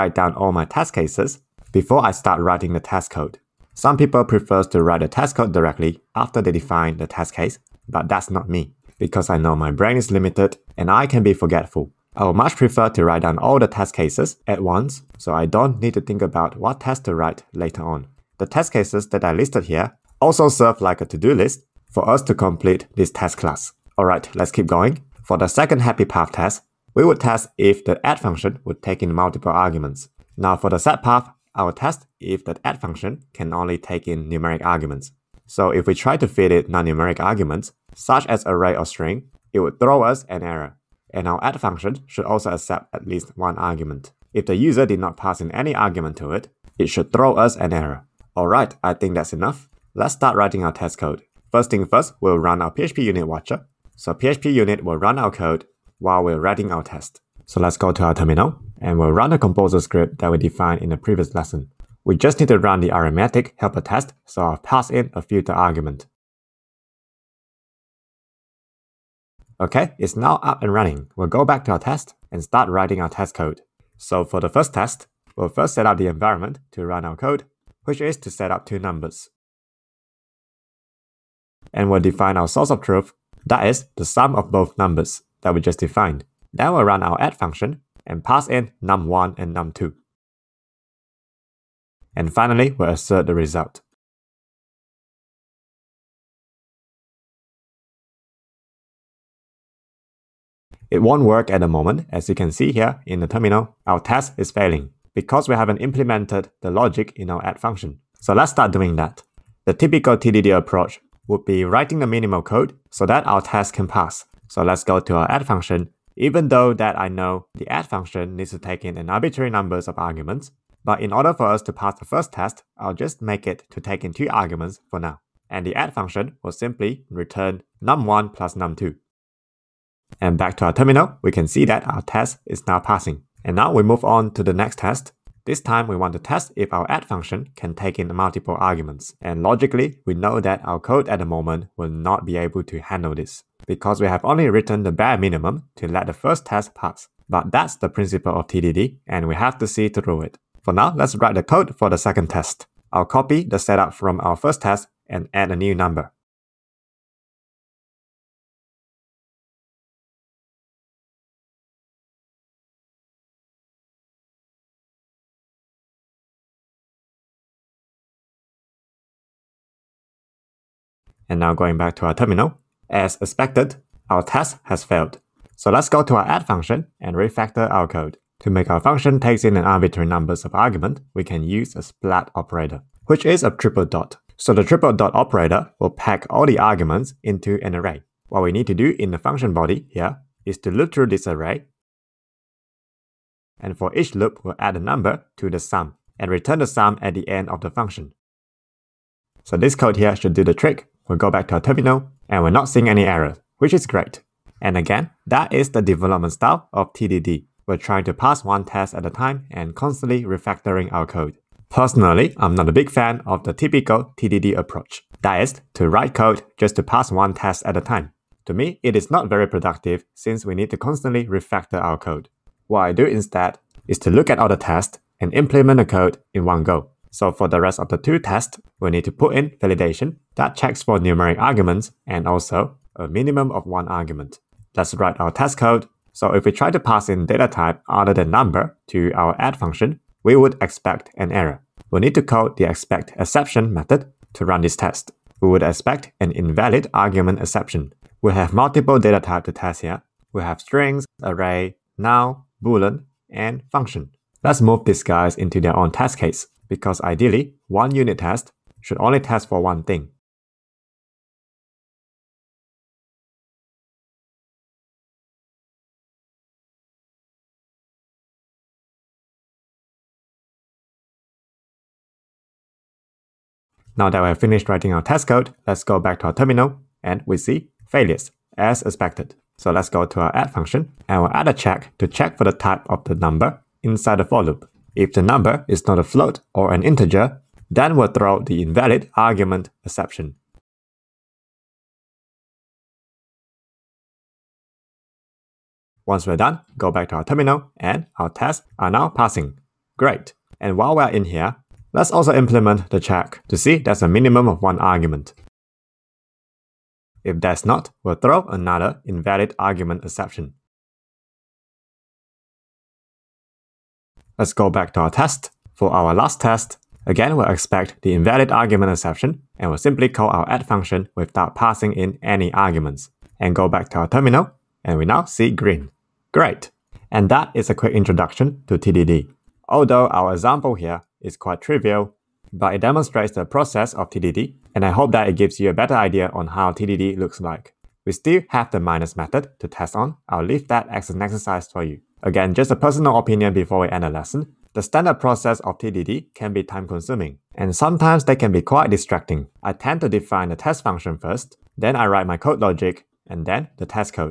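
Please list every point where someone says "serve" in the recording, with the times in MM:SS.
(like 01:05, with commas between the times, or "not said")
00:20.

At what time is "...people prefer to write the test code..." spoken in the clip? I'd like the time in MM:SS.
00:03.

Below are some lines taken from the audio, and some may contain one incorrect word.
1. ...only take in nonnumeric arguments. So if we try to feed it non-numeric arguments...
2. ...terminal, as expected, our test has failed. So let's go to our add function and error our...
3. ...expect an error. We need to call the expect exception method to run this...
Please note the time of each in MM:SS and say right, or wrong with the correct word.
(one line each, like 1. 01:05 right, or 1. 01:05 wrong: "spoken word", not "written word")
1. 00:33 wrong: "numeric", not "nonnumeric"
2. 02:52 wrong: "refactor", not "error"
3. 04:00 right.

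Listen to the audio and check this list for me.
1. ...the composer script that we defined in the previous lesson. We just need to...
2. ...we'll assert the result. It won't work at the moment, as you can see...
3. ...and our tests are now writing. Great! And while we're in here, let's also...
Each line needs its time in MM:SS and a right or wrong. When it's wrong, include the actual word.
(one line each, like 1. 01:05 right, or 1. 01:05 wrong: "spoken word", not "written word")
1. 00:59 right
2. 01:32 right
3. 04:57 wrong: "passing", not "writing".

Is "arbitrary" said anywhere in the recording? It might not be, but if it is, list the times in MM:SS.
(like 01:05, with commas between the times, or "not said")
01:59, 02:59.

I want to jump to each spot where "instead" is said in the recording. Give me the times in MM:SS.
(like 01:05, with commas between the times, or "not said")
03:43.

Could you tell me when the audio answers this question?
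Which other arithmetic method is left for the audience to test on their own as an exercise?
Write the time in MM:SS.
05:38.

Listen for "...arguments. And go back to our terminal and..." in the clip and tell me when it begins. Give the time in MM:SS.
05:22.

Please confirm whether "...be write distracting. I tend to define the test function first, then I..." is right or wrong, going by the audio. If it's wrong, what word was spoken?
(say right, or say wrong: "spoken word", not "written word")
wrong: "quite", not "write".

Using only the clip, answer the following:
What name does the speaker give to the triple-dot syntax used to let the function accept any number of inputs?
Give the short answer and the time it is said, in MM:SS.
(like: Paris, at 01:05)
splat operator, at 03:01.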